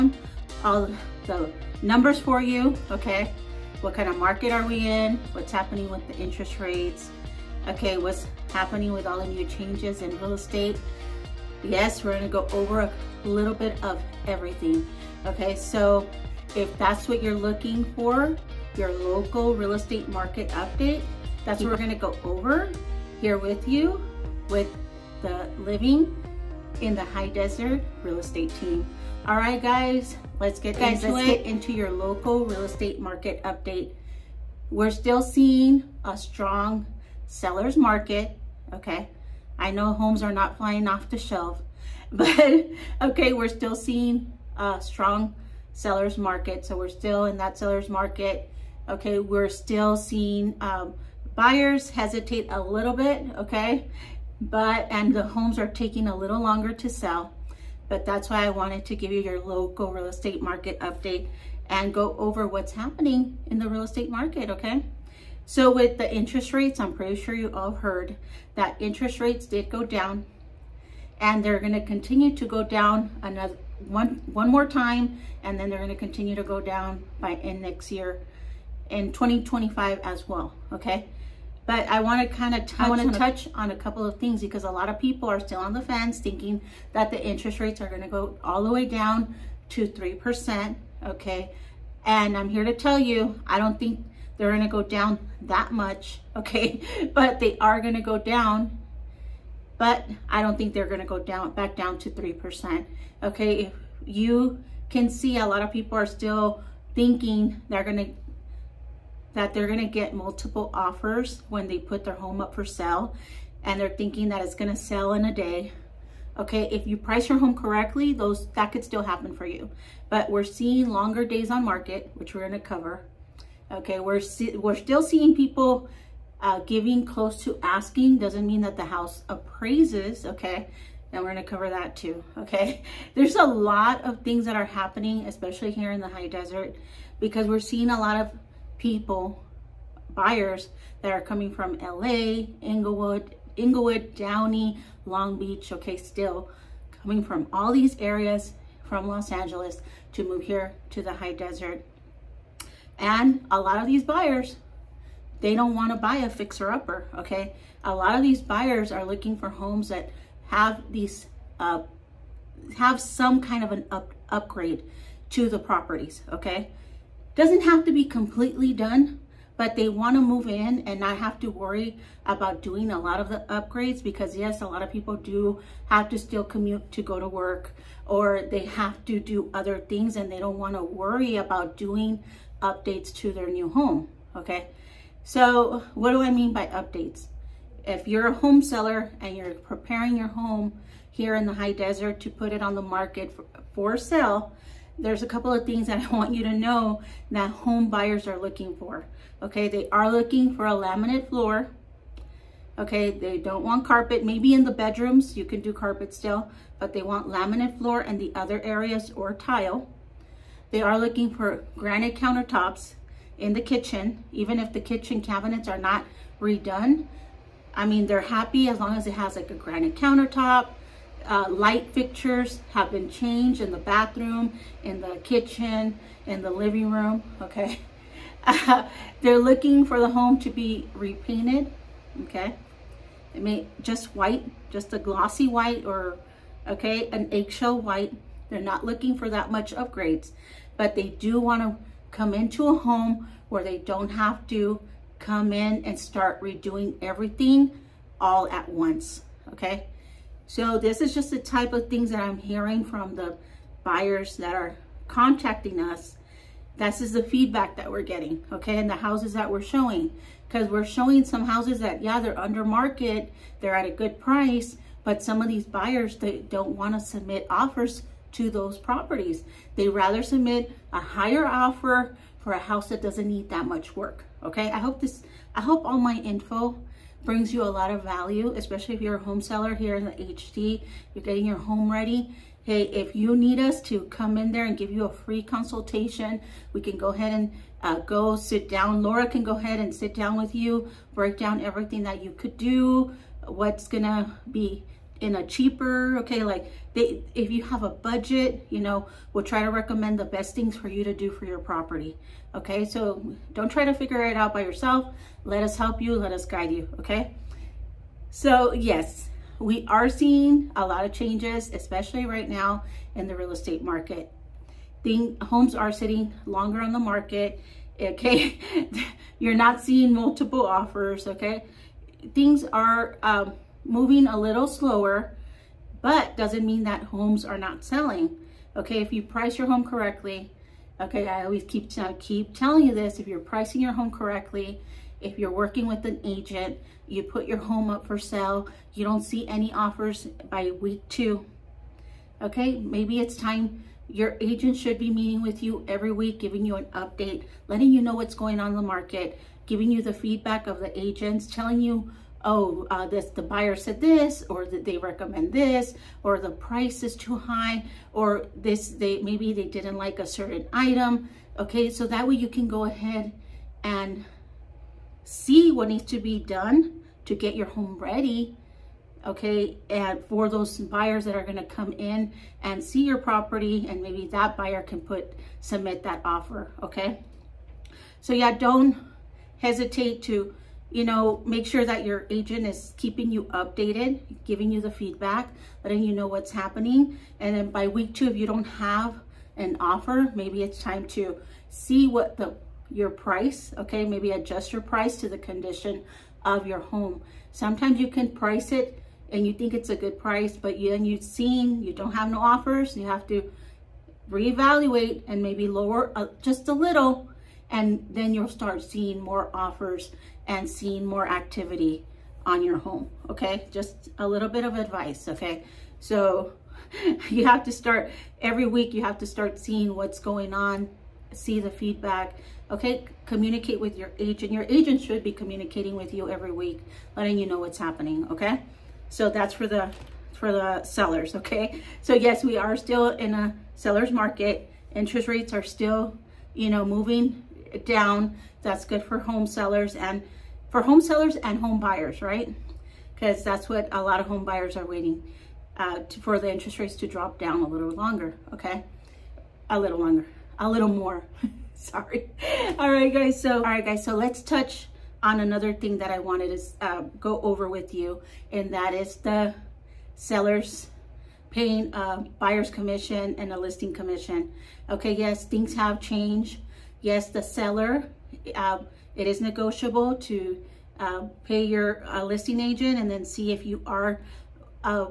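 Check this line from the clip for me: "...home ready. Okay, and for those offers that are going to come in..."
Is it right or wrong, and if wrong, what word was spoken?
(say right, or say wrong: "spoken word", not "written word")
wrong: "buyers", not "offers".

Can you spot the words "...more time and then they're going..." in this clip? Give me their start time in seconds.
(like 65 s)
74 s.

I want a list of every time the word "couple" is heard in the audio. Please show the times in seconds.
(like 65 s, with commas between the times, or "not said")
83 s, 195 s.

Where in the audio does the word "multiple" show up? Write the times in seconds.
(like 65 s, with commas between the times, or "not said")
110 s, 320 s.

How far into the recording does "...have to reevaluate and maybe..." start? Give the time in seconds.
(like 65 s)
403 s.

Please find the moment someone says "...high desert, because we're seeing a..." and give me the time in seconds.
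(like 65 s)
136 s.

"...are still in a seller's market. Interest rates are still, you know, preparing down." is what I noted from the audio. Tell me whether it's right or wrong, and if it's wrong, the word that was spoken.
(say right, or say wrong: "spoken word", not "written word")
wrong: "moving", not "preparing".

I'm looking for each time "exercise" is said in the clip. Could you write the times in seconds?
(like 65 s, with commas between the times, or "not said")
not said.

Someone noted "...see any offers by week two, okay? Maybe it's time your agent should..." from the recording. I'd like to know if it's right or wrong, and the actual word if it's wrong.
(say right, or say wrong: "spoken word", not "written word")
right.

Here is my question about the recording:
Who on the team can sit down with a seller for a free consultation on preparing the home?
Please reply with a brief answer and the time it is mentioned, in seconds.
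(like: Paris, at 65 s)
Laura, at 289 s.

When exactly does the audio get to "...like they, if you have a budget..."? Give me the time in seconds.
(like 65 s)
296 s.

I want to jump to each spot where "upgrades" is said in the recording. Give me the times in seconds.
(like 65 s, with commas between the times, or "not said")
164 s, 173 s, 239 s.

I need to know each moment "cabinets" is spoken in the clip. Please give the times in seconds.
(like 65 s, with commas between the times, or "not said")
215 s.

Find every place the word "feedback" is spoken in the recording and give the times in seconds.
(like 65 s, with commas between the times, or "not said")
257 s, 350 s, 384 s, 421 s.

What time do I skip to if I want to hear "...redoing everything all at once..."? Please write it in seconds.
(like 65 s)
246 s.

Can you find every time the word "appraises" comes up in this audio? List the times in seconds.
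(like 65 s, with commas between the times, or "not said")
129 s.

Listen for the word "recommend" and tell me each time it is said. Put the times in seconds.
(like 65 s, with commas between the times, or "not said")
299 s, 354 s.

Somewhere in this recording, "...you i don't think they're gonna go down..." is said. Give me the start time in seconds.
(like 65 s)
92 s.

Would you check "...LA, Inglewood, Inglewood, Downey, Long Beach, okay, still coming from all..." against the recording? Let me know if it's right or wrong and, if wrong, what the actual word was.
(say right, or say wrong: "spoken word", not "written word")
right.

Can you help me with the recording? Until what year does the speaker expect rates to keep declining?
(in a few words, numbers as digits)
2025.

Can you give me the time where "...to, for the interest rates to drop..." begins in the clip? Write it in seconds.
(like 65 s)
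445 s.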